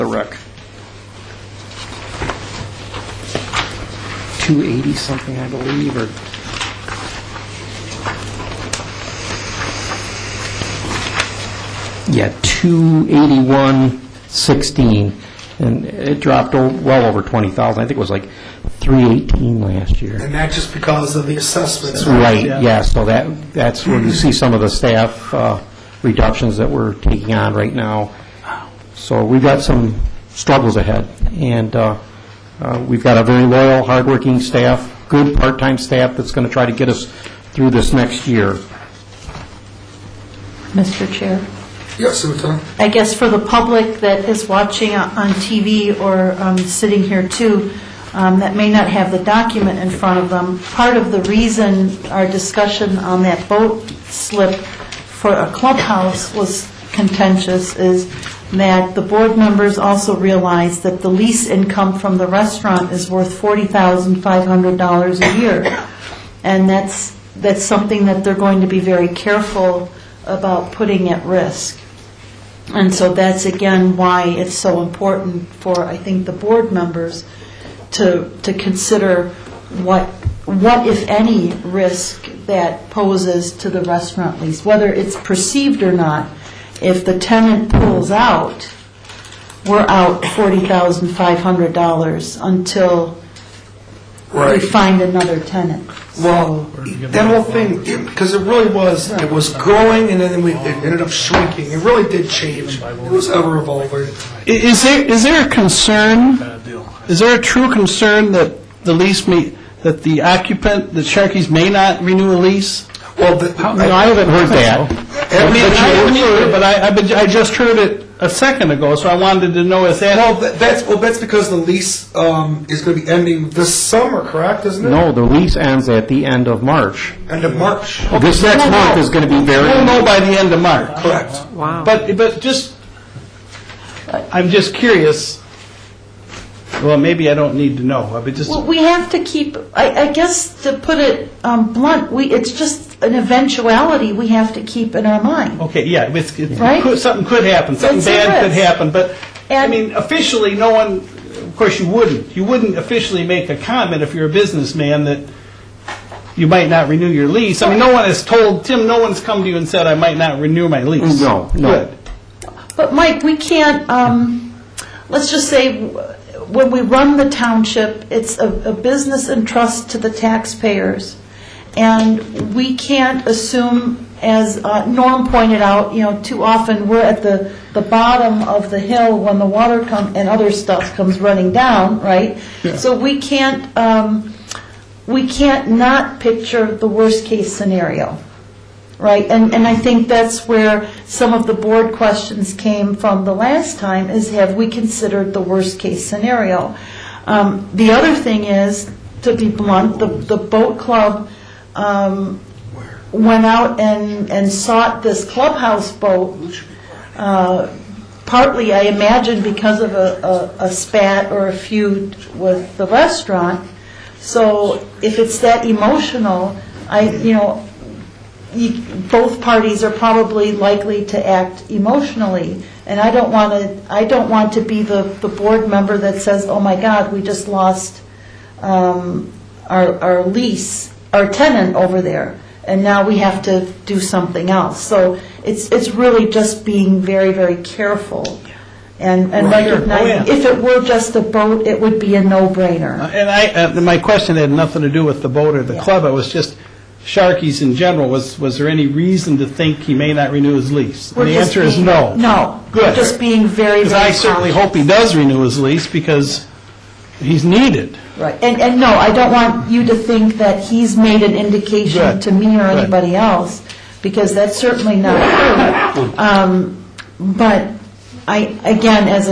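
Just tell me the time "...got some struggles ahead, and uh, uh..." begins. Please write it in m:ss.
0:29.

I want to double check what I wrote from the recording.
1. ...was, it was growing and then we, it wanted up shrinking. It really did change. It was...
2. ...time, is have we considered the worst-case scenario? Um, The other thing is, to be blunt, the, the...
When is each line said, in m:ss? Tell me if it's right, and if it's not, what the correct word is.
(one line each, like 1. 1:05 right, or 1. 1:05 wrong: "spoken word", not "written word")
1. 1:38 wrong: "ended", not "wanted"
2. 3:13 right.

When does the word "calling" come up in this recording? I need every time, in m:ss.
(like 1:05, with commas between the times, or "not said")
not said.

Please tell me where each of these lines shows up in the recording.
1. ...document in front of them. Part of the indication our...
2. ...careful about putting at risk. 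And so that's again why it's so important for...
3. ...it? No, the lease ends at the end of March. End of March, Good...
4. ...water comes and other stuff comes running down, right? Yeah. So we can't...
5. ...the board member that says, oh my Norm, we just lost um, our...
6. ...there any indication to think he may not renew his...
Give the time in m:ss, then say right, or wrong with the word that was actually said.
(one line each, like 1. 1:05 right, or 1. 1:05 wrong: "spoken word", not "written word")
1. 0:49 wrong: "reason", not "indication"
2. 1:09 right
3. 2:04 wrong: "This", not "Good"
4. 2:59 right
5. 3:45 wrong: "God", not "Norm"
6. 4:08 wrong: "reason", not "indication".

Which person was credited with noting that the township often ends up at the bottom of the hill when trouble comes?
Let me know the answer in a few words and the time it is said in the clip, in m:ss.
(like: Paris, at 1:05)
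Norm, at 2:54.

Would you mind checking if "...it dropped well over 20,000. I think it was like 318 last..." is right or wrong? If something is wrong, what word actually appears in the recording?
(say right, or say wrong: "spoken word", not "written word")
right.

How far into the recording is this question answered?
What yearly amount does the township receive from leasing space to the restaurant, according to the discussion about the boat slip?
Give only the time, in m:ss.
1:03.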